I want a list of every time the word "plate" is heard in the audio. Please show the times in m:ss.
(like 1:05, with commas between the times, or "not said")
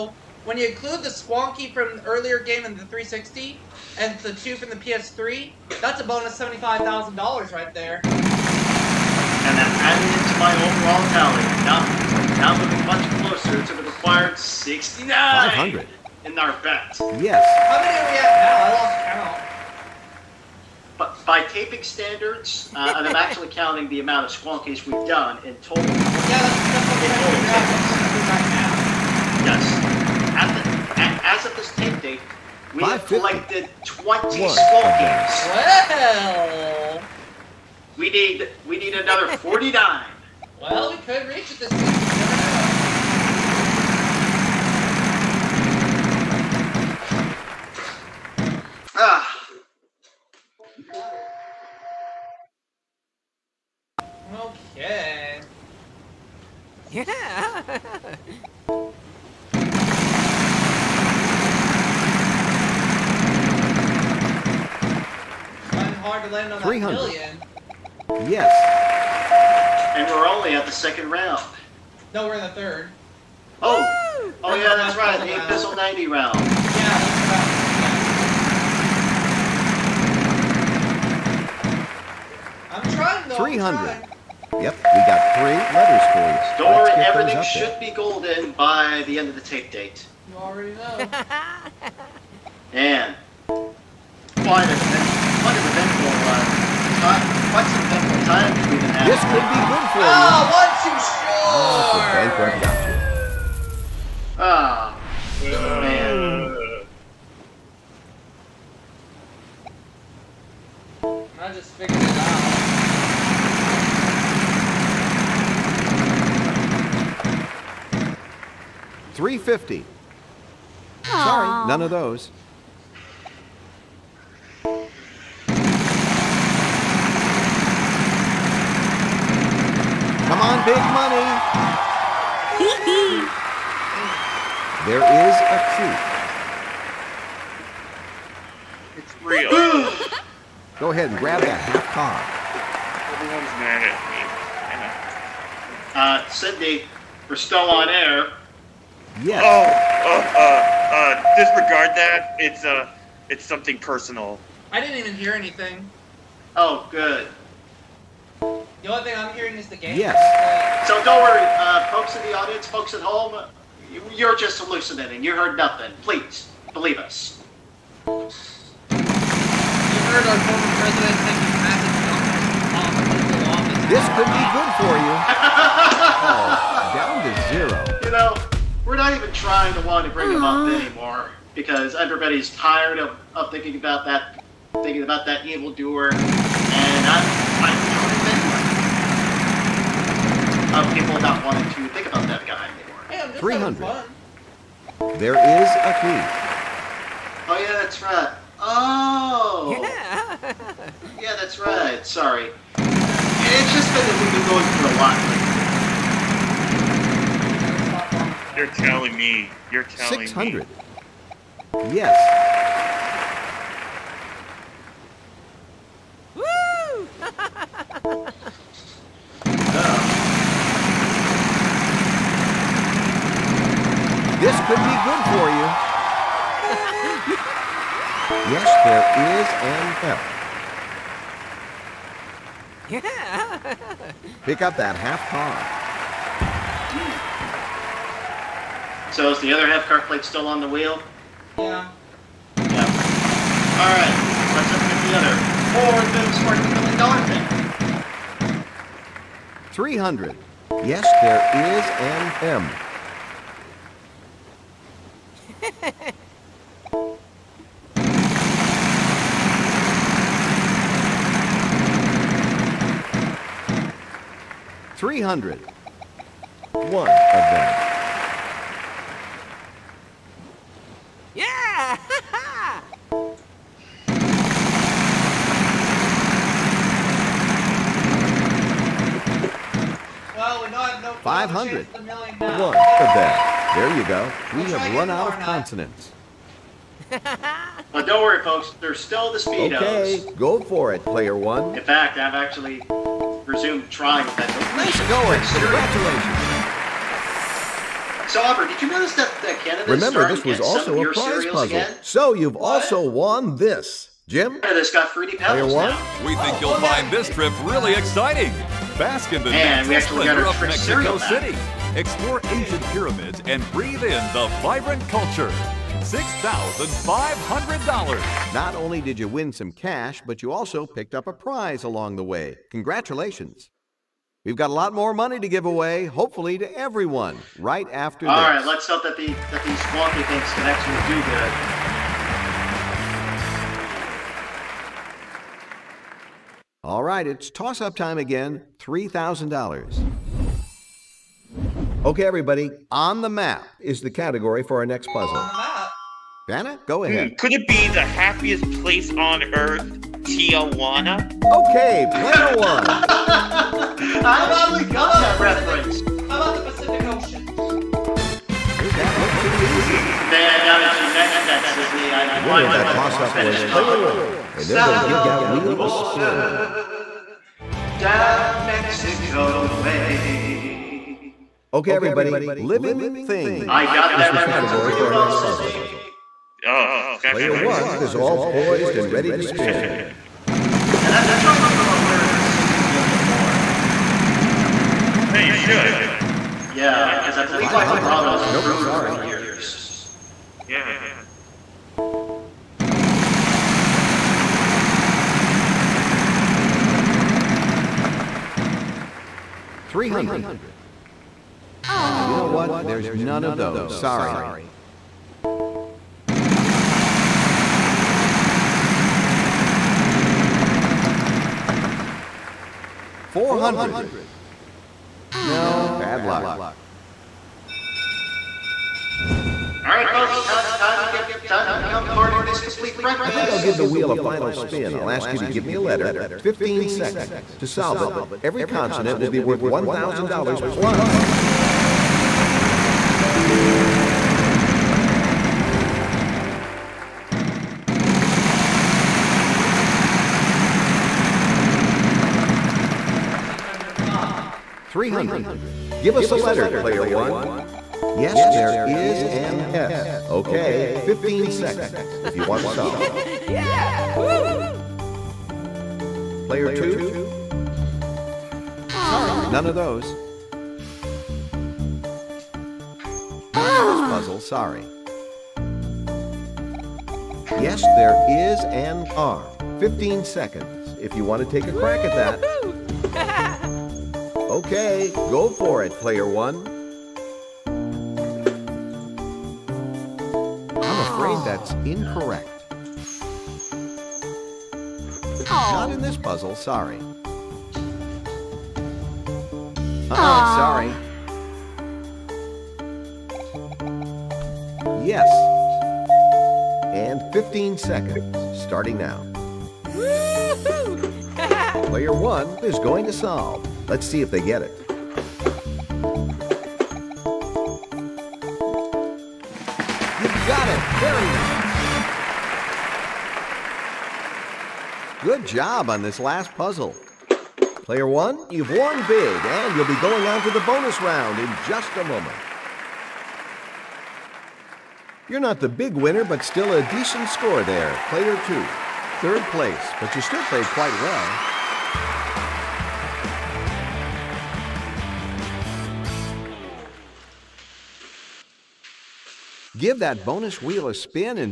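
4:00.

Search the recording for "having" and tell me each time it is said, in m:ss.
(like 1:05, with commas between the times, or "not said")
1:38.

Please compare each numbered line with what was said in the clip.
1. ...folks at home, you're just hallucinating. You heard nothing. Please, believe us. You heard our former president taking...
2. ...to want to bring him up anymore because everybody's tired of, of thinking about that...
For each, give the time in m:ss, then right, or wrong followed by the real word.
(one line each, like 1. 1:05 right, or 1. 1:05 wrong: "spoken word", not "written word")
1. 2:42 right
2. 2:59 right.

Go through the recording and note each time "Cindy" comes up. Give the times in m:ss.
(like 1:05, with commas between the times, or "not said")
2:26, 6:15.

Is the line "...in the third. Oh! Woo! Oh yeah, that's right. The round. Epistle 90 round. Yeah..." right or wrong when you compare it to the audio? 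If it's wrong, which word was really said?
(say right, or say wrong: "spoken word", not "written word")
right.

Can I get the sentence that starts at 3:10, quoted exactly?
of people not wanting to think about that guy anymore.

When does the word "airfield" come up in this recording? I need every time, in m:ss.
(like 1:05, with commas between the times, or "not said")
not said.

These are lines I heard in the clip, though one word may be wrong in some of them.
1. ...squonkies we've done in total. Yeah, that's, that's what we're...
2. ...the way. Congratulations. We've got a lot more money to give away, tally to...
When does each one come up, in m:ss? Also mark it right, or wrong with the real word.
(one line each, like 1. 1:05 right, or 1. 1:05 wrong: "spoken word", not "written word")
1. 0:24 right
2. 5:22 wrong: "hopefully", not "tally".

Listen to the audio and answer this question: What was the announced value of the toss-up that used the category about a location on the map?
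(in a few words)
$3,000.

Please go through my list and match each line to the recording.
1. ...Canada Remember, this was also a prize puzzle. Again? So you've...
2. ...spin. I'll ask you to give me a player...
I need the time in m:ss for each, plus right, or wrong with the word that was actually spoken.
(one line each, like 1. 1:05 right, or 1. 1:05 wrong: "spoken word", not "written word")
1. 4:59 right
2. 7:04 wrong: "letter", not "player".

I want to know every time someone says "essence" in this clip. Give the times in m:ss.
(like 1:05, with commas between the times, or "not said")
not said.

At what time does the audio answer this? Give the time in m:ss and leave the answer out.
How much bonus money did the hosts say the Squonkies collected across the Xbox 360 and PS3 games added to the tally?
0:06.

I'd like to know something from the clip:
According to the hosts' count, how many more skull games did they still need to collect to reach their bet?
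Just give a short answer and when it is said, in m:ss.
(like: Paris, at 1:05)
49, at 0:39.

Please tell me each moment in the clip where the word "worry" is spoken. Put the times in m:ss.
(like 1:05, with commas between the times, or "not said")
2:41, 4:48.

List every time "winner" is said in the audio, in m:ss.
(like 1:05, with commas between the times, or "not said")
6:02, 8:45.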